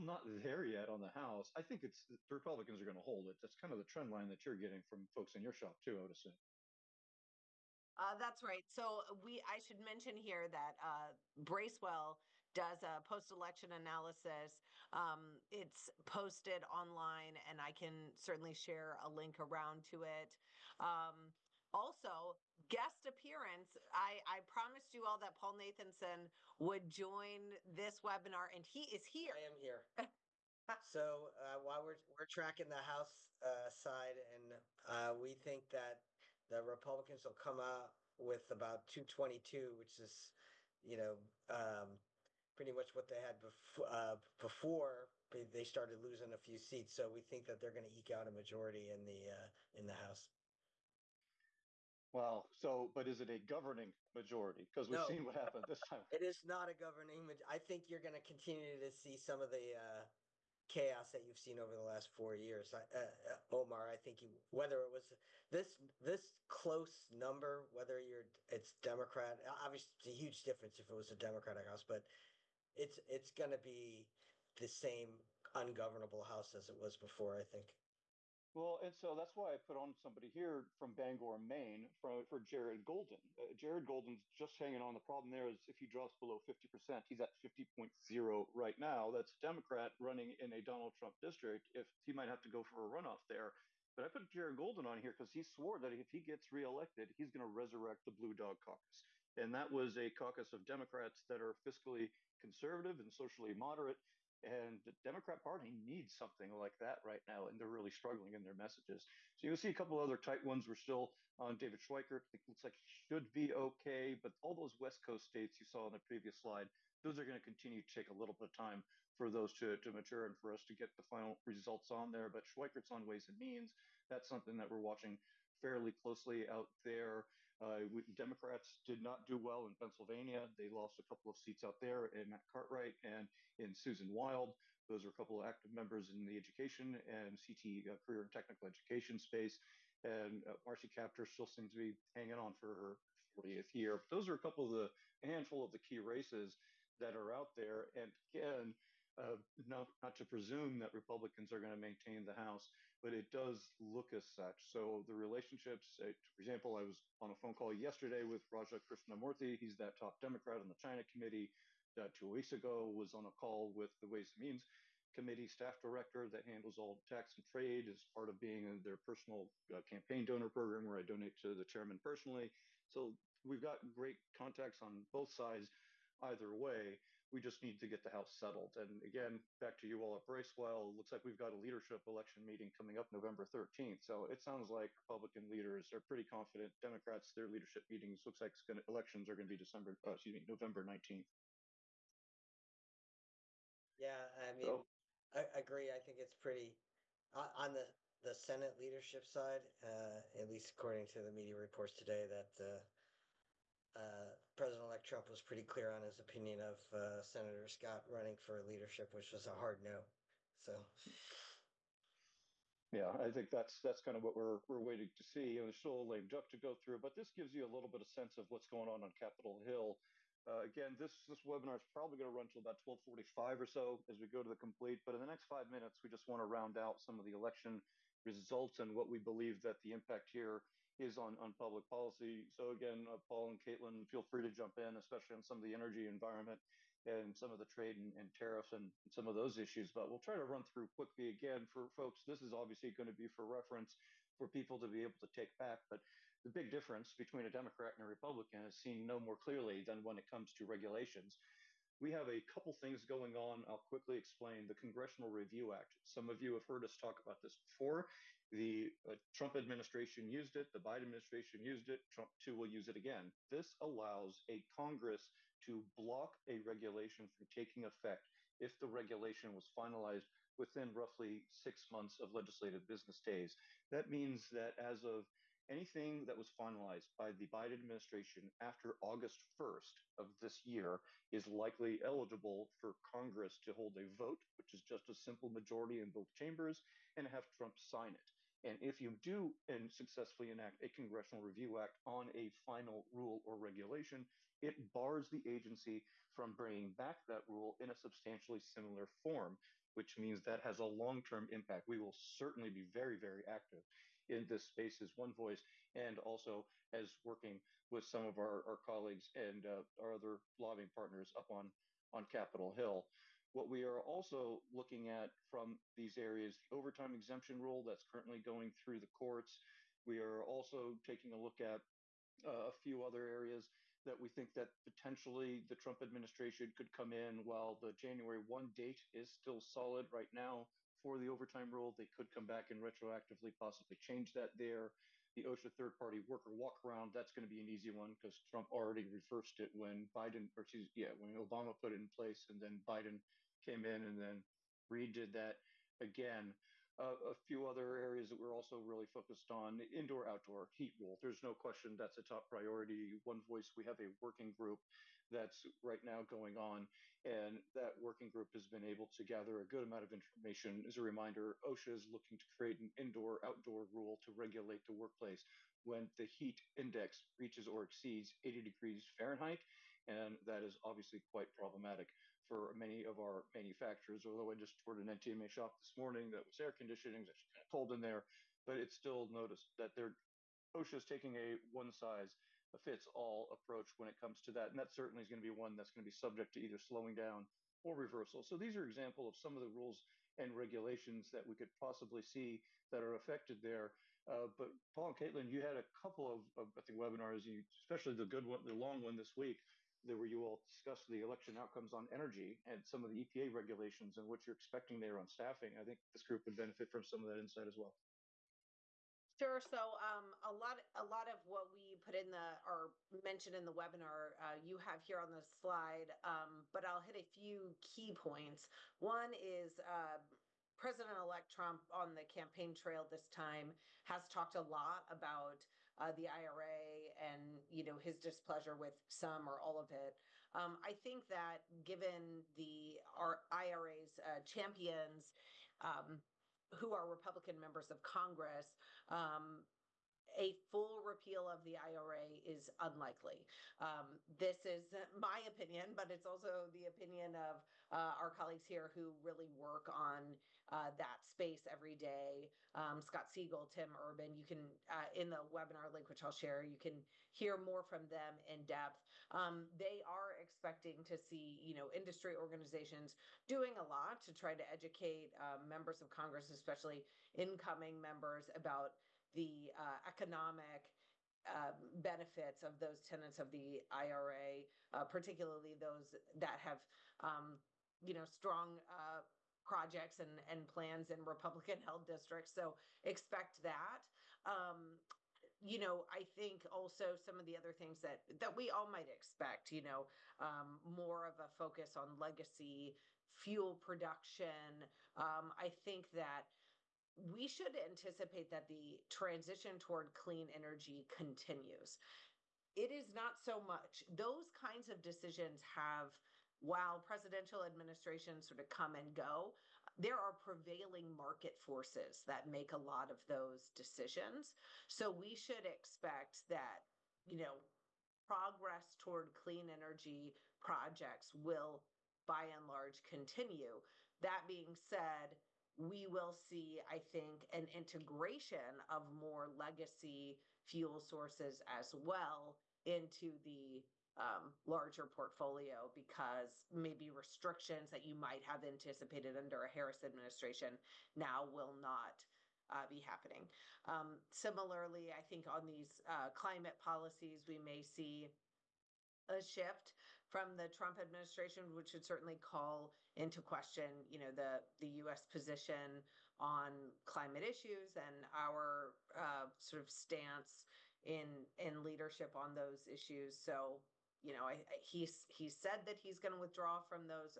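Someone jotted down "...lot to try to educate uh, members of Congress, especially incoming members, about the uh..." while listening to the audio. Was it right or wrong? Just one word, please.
right.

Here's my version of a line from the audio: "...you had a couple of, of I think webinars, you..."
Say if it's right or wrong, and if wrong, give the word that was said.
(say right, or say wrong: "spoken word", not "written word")
right.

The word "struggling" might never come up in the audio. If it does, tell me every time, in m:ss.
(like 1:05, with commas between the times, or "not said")
1:47.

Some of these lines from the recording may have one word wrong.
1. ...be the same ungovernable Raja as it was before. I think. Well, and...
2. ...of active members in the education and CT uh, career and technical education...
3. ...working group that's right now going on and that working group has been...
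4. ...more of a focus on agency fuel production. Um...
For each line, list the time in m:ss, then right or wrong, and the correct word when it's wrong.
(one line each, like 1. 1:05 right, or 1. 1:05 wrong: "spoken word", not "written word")
1. 1:13 wrong: "House", not "Raja"
2. 2:15 right
3. 5:54 right
4. 8:10 wrong: "legacy", not "agency".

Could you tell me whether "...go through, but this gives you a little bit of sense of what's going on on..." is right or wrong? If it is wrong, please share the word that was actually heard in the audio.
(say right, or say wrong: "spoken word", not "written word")
right.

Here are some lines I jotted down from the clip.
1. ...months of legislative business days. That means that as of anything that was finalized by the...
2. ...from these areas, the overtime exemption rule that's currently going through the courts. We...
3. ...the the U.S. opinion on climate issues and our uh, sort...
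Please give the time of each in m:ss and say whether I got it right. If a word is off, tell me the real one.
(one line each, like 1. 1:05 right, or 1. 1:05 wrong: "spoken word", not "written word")
1. 4:31 right
2. 5:15 right
3. 9:14 wrong: "position", not "opinion".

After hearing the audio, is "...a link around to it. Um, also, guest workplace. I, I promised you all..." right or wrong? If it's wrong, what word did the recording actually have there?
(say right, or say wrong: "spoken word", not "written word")
wrong: "appearance", not "workplace".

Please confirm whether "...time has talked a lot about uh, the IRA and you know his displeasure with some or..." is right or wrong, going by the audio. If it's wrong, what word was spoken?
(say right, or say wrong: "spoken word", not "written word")
right.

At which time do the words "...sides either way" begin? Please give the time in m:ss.
2:55.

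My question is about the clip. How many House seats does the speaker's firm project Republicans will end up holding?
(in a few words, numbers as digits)
222.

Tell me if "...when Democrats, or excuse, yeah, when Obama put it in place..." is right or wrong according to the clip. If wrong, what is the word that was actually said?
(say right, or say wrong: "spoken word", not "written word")
wrong: "Biden", not "Democrats".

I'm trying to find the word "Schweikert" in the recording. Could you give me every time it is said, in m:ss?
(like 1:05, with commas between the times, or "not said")
1:51, 2:02.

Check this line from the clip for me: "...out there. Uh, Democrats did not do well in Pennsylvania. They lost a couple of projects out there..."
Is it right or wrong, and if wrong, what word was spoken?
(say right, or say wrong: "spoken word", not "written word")
wrong: "seats", not "projects".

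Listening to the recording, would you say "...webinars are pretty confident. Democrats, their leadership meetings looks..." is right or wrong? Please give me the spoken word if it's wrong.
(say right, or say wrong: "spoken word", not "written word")
wrong: "leaders", not "webinars".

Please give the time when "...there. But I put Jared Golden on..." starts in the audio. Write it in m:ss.
1:33.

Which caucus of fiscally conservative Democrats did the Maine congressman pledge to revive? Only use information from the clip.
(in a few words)
Blue Dog Caucus.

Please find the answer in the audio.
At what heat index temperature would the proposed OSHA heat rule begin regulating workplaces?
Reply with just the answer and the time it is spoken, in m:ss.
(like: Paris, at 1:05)
80 degrees Fahrenheit, at 6:08.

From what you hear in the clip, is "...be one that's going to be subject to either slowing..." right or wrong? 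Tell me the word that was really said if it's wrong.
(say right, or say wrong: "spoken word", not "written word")
right.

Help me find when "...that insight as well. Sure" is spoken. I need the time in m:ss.
6:47.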